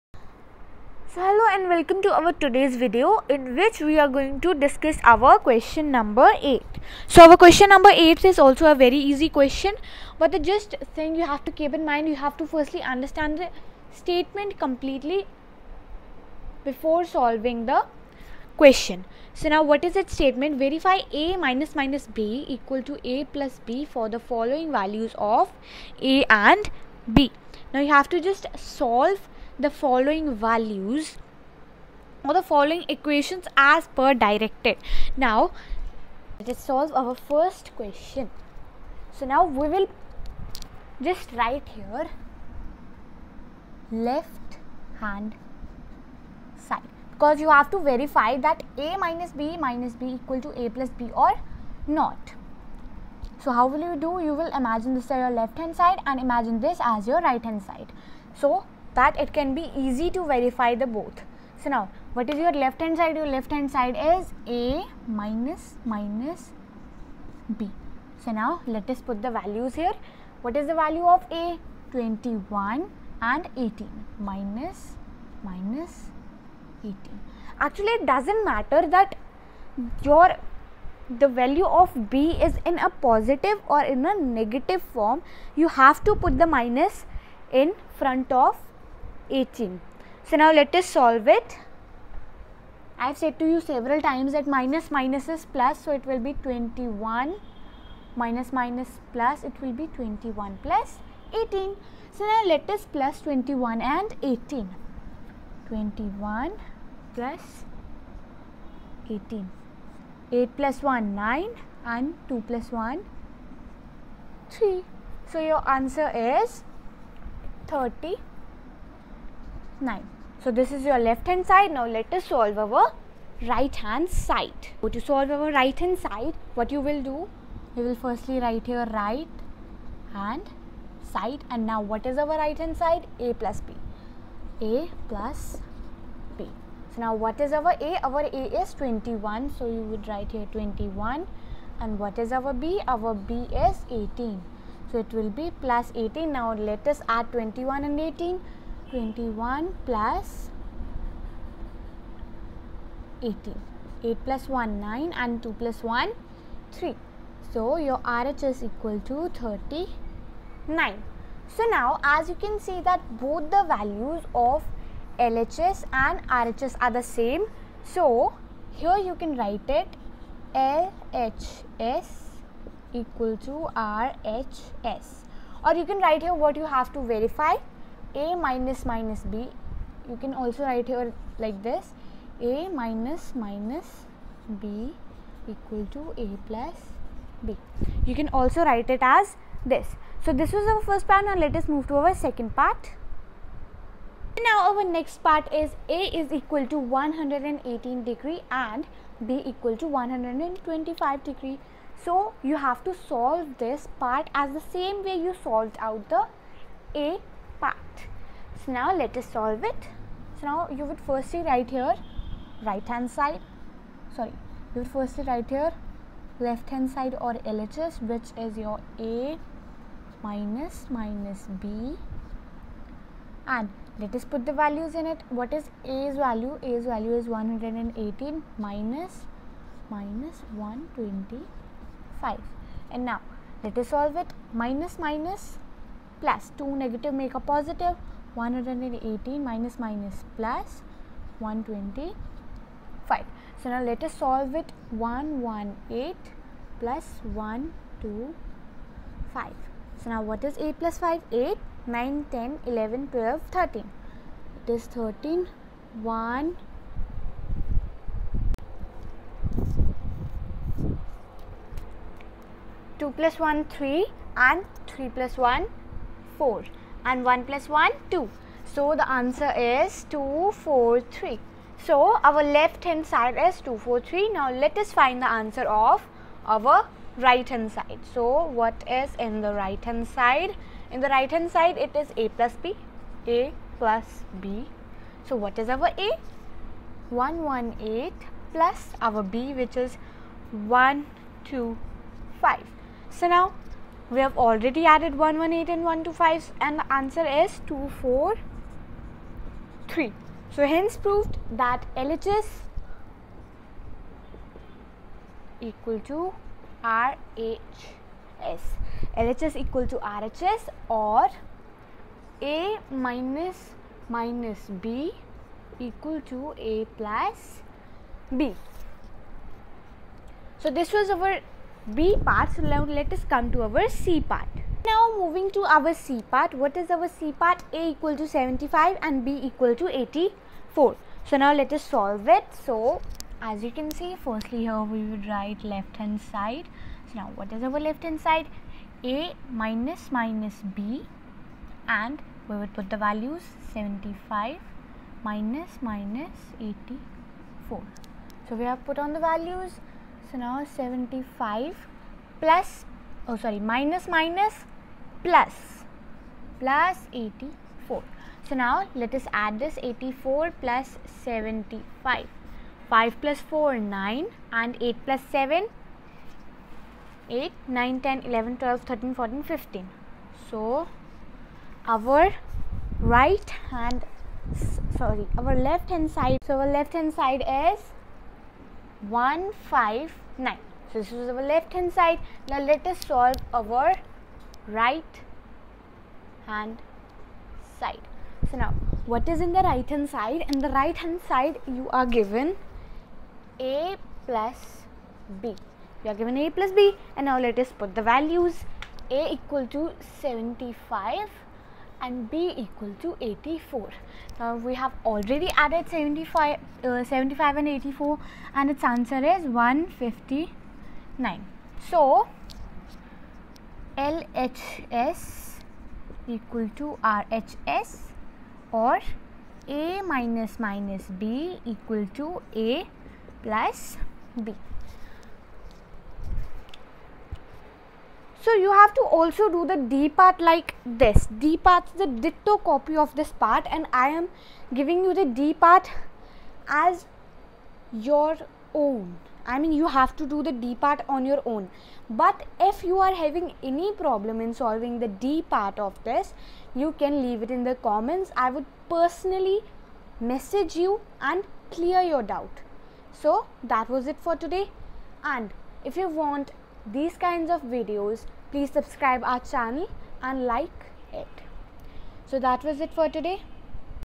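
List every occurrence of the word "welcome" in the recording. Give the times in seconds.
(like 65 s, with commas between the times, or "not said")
1 s.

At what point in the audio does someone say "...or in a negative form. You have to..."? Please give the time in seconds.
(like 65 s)
83 s.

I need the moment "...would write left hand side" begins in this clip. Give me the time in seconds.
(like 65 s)
335 s.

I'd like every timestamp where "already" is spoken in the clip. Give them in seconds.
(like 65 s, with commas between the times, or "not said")
294 s, 405 s.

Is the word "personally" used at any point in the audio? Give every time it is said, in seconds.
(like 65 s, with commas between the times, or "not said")
448 s.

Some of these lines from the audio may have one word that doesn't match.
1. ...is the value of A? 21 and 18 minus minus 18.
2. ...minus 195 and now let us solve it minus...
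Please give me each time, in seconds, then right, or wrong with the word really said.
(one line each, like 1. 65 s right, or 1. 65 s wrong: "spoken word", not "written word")
1. 70 s right
2. 229 s wrong: "125", not "195".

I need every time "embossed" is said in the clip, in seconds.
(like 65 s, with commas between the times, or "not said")
not said.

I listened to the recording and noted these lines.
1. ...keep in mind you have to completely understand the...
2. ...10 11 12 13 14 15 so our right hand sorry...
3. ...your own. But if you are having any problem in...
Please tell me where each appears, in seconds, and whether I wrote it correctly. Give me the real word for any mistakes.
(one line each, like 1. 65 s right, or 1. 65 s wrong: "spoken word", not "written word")
1. 11 s wrong: "firstly", not "completely"
2. 368 s right
3. 441 s right.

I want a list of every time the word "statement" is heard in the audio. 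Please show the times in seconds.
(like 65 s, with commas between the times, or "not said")
13 s, 20 s.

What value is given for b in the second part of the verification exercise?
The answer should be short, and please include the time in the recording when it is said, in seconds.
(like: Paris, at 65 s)
125, at 199 s.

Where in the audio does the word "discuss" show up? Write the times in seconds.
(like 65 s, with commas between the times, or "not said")
4 s.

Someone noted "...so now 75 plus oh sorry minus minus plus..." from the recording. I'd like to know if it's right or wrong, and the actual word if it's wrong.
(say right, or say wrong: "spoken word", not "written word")
right.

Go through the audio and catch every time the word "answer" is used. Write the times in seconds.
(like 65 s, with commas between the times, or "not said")
115 s, 269 s, 275 s, 296 s, 408 s.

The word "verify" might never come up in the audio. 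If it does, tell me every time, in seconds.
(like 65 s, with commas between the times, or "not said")
20 s, 47 s, 60 s, 176 s.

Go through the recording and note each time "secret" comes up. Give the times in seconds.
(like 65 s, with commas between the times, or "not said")
not said.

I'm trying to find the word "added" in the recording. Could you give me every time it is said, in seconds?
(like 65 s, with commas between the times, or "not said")
294 s, 405 s.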